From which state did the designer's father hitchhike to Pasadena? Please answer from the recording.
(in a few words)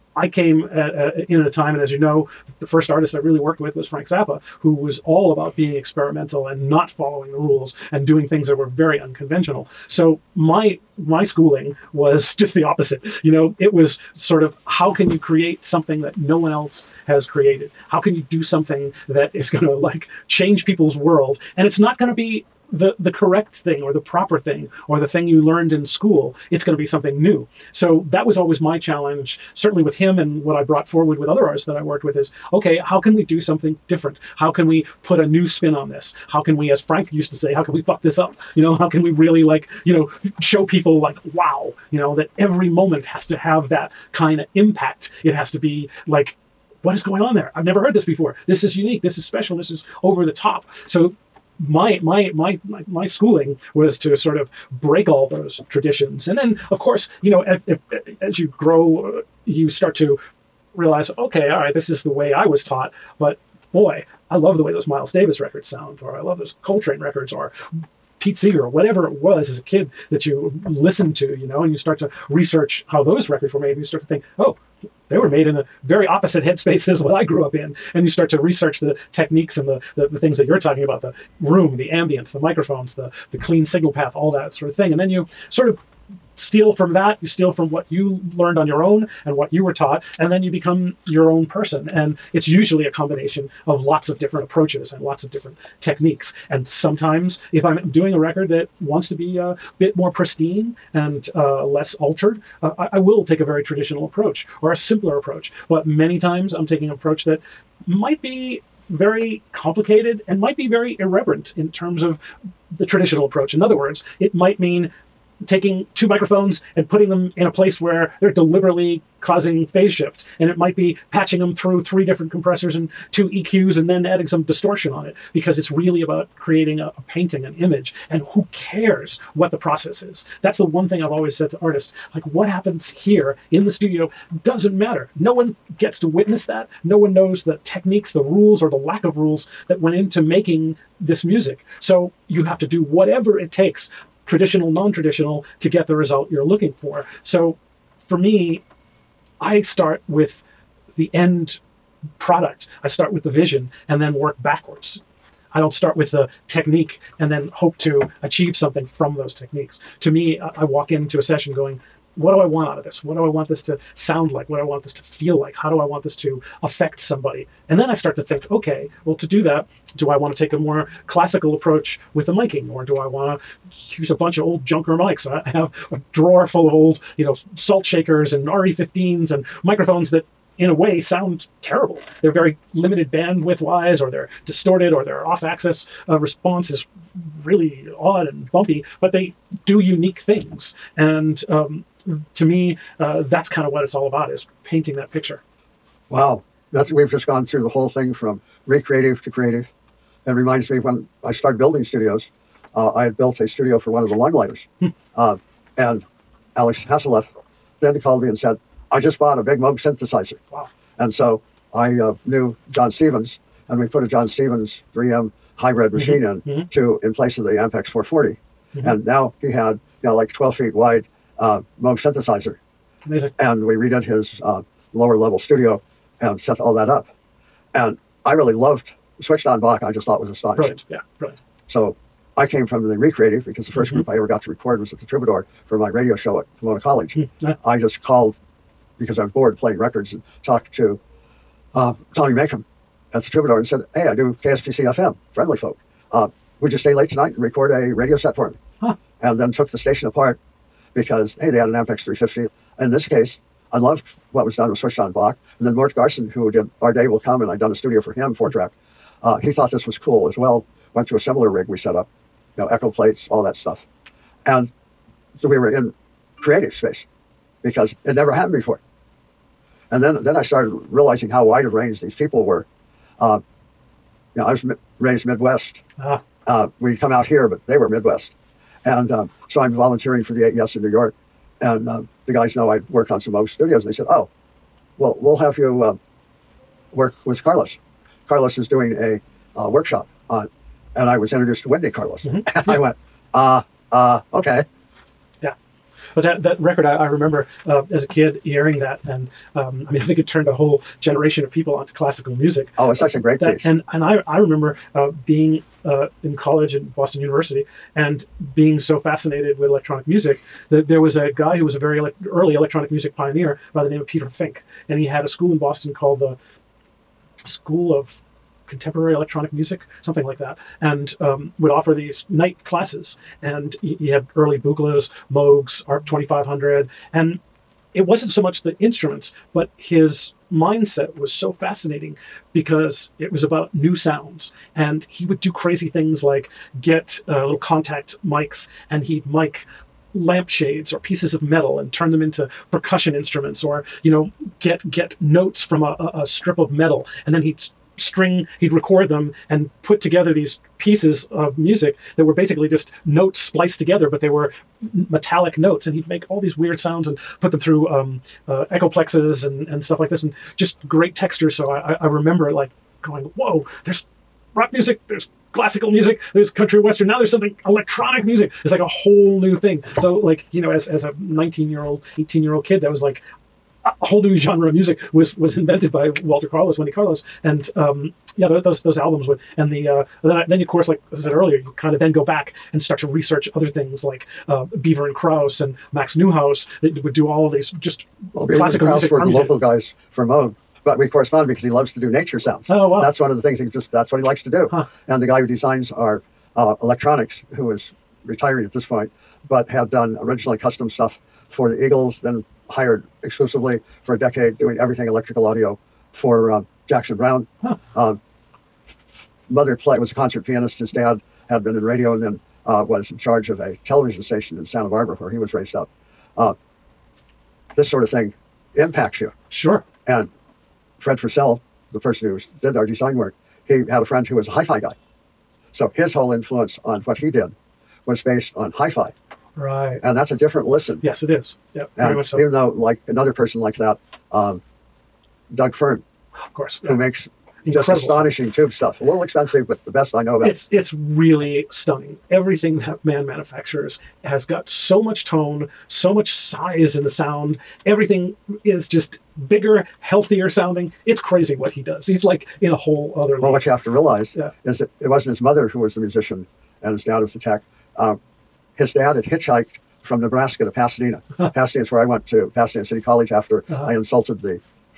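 Nebraska.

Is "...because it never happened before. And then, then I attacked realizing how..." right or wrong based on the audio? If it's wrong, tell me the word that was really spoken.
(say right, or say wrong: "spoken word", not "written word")
wrong: "started", not "attacked".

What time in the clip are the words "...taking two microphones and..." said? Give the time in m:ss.
1:55.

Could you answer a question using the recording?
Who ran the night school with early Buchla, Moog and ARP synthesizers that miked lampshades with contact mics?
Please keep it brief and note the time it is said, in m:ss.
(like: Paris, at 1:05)
Peter Fink, at 5:14.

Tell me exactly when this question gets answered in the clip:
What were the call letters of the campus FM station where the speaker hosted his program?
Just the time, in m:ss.
4:04.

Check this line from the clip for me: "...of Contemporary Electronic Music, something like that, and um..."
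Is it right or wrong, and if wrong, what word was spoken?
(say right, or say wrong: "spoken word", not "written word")
right.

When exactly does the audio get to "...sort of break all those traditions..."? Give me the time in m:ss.
0:54.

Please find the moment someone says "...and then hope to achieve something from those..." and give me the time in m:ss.
2:37.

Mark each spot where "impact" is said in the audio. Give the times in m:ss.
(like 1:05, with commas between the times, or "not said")
0:44, 6:58.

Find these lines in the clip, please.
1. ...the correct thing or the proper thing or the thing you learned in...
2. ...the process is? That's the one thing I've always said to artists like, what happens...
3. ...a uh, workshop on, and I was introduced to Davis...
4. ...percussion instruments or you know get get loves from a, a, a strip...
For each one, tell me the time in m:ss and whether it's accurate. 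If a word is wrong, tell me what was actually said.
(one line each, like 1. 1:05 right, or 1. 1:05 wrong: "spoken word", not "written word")
1. 0:22 right
2. 2:09 right
3. 4:48 wrong: "Wendy", not "Davis"
4. 5:42 wrong: "notes", not "loves".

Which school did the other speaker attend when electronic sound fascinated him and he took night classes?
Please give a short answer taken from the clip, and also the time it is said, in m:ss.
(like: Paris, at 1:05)
Boston University, at 5:06.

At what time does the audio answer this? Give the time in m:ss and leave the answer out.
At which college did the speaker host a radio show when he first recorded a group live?
3:56.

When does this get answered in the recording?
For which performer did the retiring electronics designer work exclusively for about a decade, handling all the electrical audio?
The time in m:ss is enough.
6:46.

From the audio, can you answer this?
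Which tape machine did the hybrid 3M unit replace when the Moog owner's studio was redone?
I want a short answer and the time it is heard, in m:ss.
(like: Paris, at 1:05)
Ampex 440, at 3:37.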